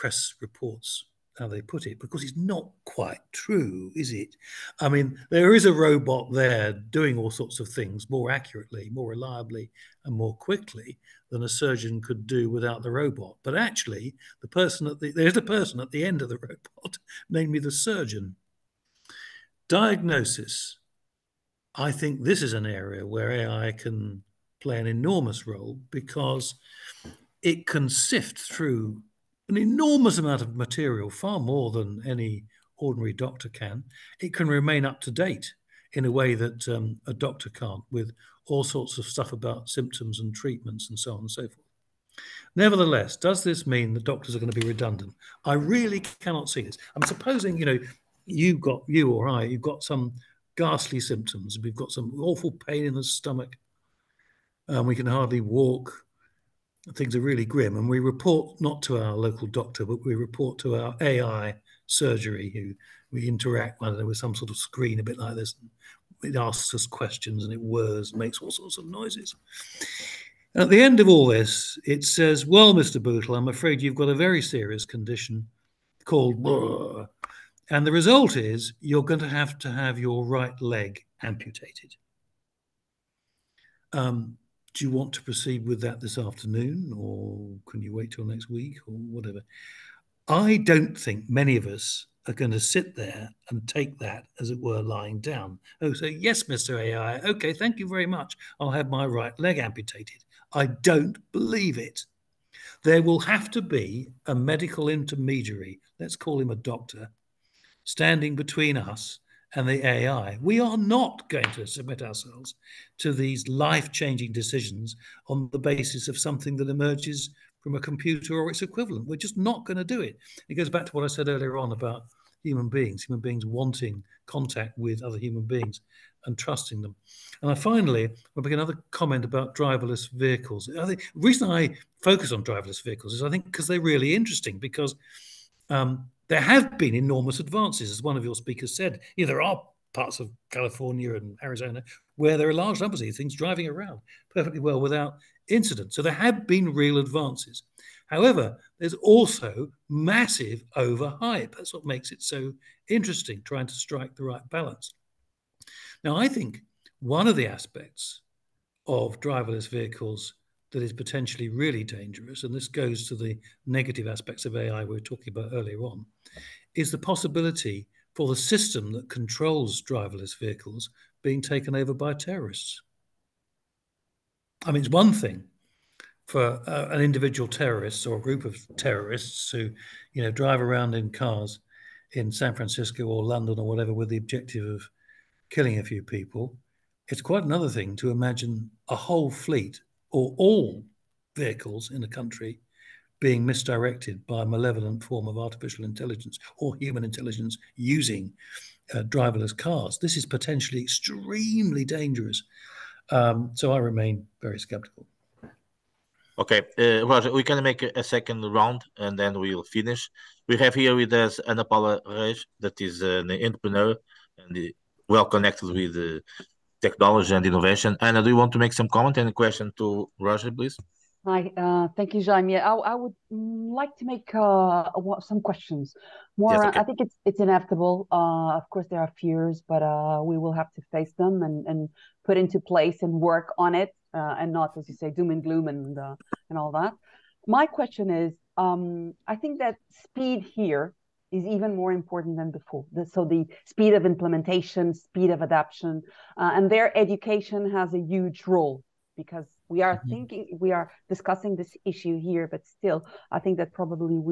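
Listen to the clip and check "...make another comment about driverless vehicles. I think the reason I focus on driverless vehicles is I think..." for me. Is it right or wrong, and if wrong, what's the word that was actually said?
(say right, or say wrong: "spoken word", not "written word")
right.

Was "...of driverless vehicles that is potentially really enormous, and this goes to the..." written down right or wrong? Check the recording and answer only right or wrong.
wrong.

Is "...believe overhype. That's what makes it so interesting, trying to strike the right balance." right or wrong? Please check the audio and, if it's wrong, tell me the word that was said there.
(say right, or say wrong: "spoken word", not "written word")
wrong: "massive", not "believe".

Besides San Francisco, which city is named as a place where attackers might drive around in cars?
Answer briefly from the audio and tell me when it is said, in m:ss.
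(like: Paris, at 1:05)
London, at 3:03.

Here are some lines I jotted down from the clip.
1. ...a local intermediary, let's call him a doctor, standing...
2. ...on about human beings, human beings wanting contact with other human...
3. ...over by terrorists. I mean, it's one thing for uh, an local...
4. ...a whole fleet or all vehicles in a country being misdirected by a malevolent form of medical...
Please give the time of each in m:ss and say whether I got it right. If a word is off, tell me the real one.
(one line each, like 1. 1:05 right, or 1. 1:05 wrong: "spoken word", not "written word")
1. 1:44 wrong: "medical", not "local"
2. 2:01 right
3. 2:51 wrong: "individual", not "local"
4. 3:08 wrong: "artificial", not "medical".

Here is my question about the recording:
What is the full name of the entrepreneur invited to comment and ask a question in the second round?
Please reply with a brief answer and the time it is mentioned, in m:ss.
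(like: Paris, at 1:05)
Ana Paula Reis, at 3:31.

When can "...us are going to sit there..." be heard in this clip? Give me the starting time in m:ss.
1:31.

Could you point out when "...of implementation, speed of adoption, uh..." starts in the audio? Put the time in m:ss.
4:03.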